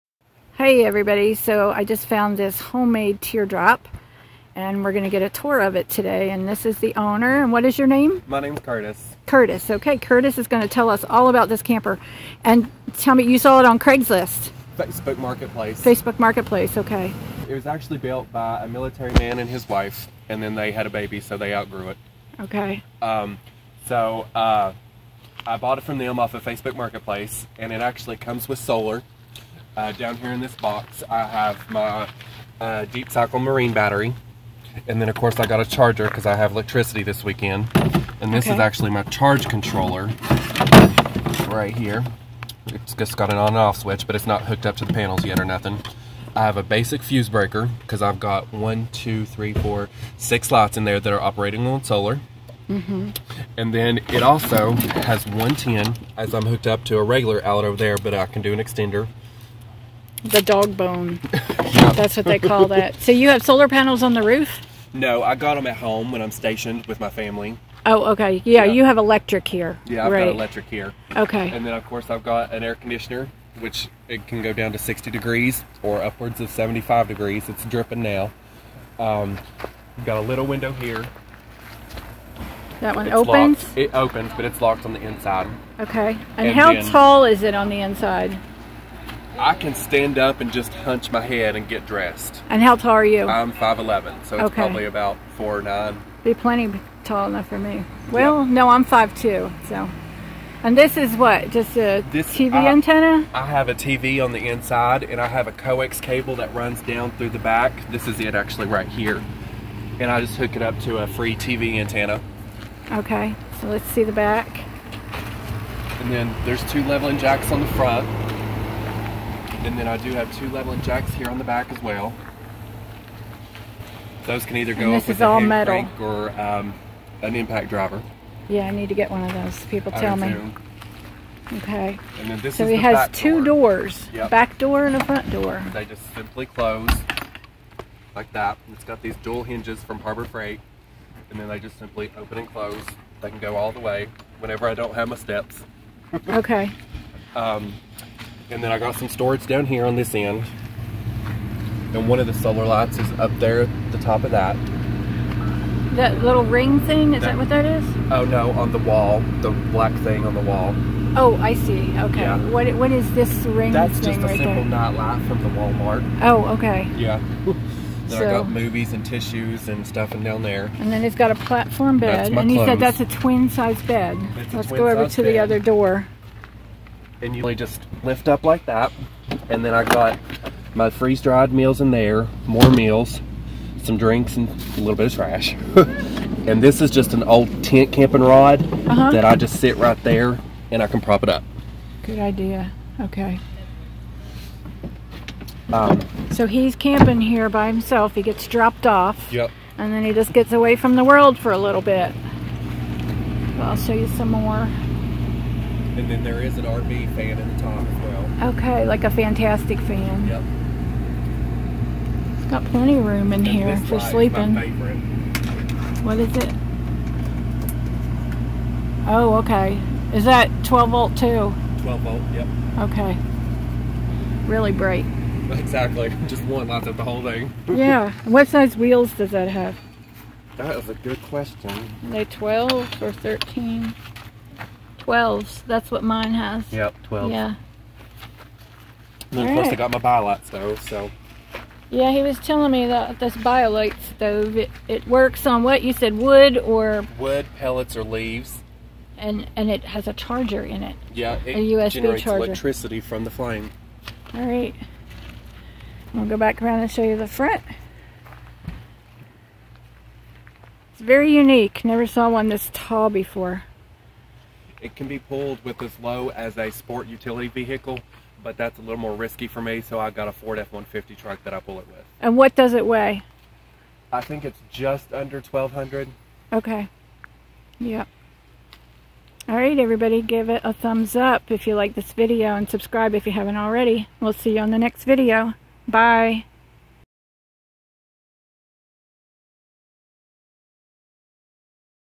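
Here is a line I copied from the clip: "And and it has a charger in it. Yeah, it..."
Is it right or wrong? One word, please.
right.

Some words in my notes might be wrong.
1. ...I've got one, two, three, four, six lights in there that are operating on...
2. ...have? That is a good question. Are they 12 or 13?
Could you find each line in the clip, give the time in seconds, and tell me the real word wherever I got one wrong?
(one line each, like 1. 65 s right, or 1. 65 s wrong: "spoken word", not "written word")
1. 48 s right
2. 229 s right.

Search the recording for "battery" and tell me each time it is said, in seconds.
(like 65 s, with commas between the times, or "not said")
33 s.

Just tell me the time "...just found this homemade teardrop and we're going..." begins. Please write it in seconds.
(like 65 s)
1 s.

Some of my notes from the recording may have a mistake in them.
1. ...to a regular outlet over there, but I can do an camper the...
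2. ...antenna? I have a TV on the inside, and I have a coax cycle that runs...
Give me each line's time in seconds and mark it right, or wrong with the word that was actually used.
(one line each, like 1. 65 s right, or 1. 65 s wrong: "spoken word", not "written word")
1. 56 s wrong: "extender", not "camper"
2. 102 s wrong: "cable", not "cycle".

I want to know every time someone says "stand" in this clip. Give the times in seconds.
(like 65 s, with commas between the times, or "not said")
89 s.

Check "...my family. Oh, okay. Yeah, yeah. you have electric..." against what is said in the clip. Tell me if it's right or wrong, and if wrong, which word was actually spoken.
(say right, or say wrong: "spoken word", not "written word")
right.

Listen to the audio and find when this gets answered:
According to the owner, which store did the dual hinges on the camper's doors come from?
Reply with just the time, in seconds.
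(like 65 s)
139 s.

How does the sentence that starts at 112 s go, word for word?
Okay, so let's see the back.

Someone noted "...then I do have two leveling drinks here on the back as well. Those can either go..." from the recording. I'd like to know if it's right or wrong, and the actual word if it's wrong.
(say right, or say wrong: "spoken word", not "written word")
wrong: "jacks", not "drinks".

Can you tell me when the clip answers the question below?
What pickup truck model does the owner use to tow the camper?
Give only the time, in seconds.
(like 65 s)
270 s.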